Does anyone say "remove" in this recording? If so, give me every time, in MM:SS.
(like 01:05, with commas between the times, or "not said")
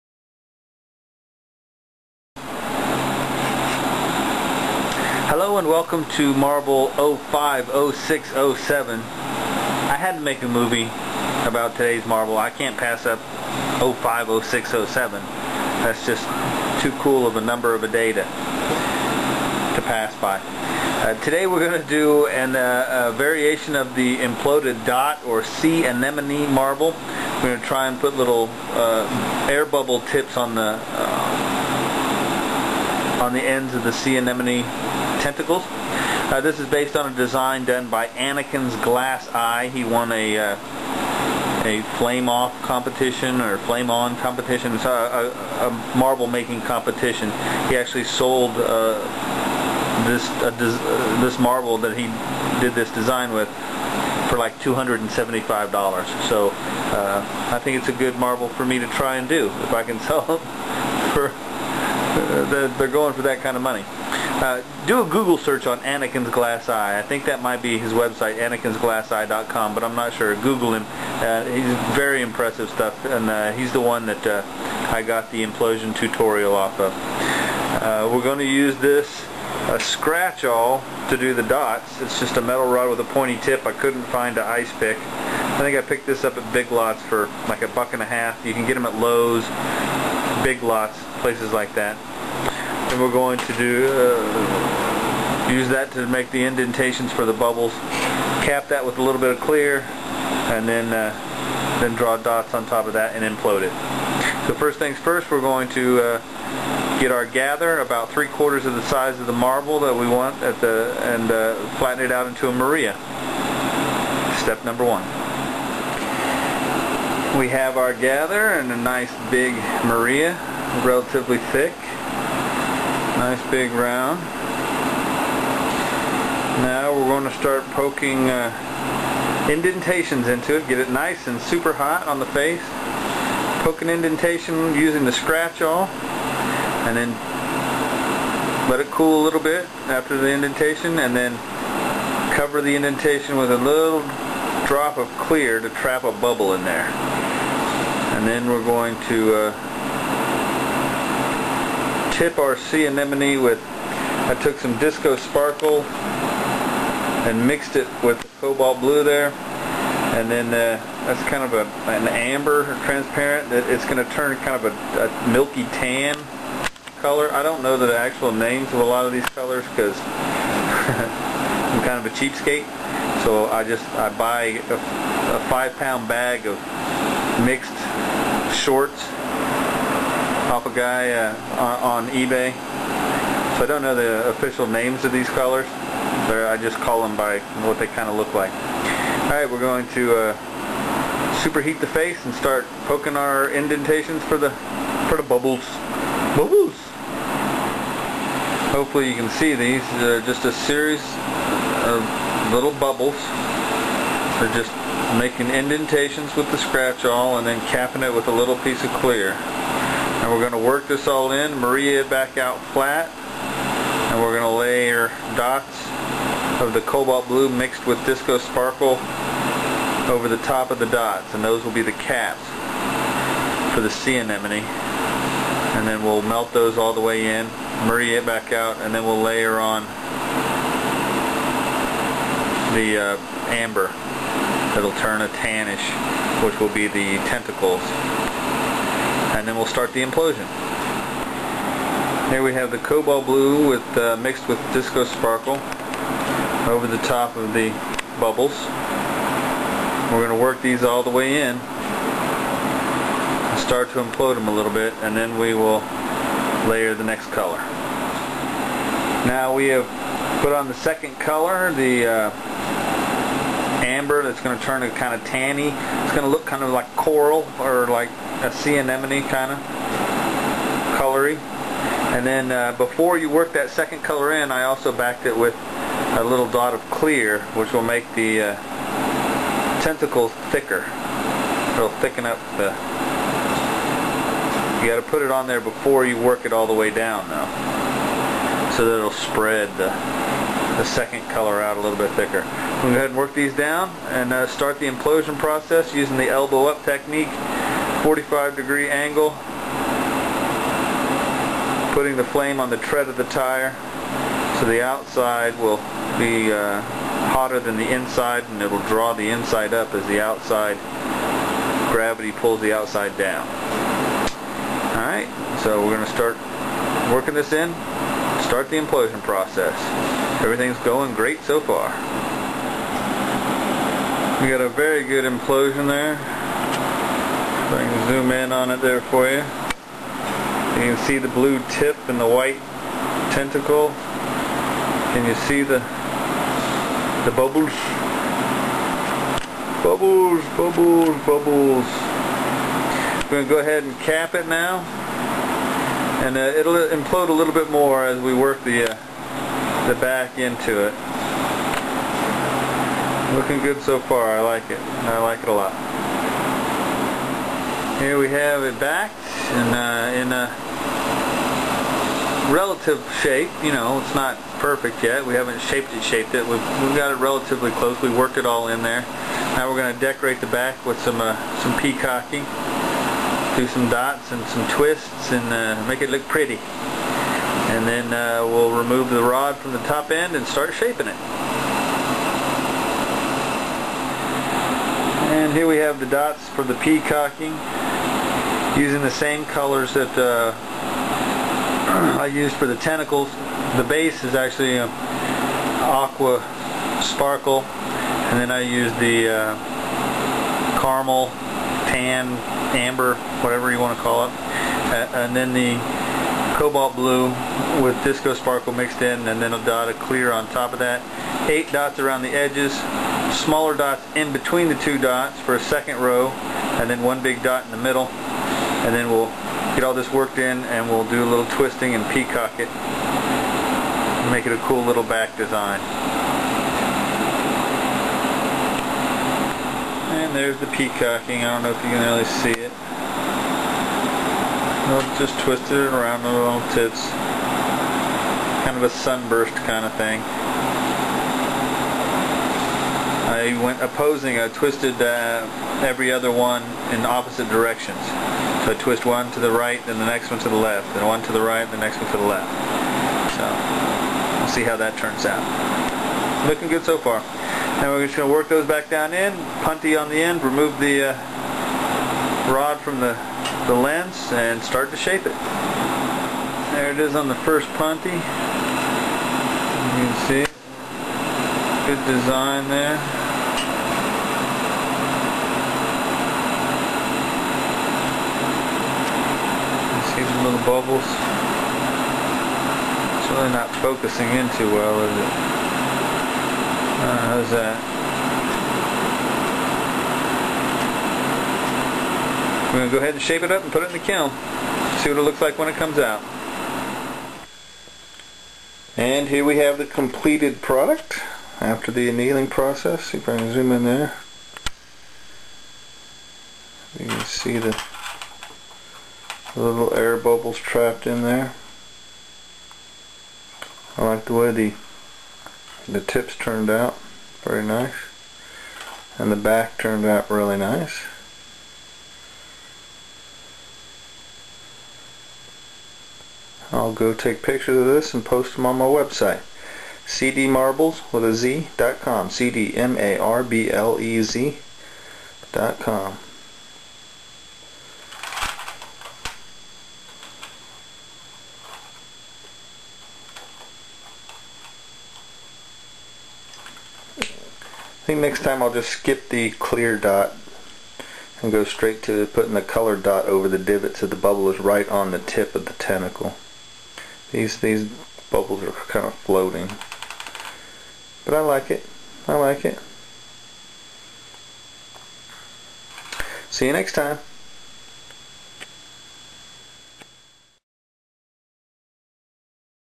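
06:18, 07:40.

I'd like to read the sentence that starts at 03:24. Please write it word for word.
They're just making indentations with the scratch awl and then capping it with a little piece of clear.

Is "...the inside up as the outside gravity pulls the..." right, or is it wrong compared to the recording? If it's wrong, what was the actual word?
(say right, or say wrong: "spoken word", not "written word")
right.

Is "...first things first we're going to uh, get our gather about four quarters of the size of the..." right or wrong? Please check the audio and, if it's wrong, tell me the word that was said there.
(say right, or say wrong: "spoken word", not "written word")
wrong: "three", not "four".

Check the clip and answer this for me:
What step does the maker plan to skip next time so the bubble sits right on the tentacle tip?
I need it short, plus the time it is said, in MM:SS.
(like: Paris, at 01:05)
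the clear dot, at 09:09.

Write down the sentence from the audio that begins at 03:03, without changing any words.
So I don't know the official names of these colors.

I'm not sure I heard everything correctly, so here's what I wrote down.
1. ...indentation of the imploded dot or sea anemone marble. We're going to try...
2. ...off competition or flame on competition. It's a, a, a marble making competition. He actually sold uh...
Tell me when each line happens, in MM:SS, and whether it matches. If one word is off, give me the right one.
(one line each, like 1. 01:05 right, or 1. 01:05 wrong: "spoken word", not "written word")
1. 00:23 wrong: "variation", not "indentation"
2. 00:42 right.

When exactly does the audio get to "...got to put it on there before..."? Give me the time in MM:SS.
04:44.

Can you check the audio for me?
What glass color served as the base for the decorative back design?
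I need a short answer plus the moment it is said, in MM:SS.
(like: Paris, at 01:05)
aqua sparkle, at 06:35.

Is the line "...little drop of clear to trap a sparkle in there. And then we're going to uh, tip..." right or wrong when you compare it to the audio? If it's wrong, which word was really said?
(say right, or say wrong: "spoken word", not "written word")
wrong: "bubble", not "sparkle".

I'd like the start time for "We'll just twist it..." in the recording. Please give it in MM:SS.
07:14.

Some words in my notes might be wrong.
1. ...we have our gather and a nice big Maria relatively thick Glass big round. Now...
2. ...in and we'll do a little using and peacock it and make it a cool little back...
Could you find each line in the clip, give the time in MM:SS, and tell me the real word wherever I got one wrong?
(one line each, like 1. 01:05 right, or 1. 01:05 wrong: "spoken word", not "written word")
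1. 01:57 wrong: "Nice", not "Glass"
2. 07:00 wrong: "twisting", not "using".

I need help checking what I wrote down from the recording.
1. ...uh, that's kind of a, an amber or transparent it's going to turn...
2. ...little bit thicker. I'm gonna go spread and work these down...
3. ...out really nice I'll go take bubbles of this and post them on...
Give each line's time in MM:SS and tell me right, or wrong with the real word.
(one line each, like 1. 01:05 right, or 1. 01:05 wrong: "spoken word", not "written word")
1. 02:40 right
2. 04:51 wrong: "ahead", not "spread"
3. 08:40 wrong: "pictures", not "bubbles".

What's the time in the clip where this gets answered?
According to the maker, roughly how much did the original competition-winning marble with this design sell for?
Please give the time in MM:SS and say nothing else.
00:54.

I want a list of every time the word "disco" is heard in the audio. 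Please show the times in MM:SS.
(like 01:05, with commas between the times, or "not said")
02:34, 03:38, 04:04, 06:48.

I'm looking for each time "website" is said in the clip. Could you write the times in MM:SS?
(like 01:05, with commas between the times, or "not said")
01:07, 08:48.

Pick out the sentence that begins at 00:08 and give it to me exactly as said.
I had to make a movie about today's Marble.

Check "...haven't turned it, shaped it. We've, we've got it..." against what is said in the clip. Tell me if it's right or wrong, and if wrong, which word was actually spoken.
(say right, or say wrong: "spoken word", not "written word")
wrong: "shaped", not "turned".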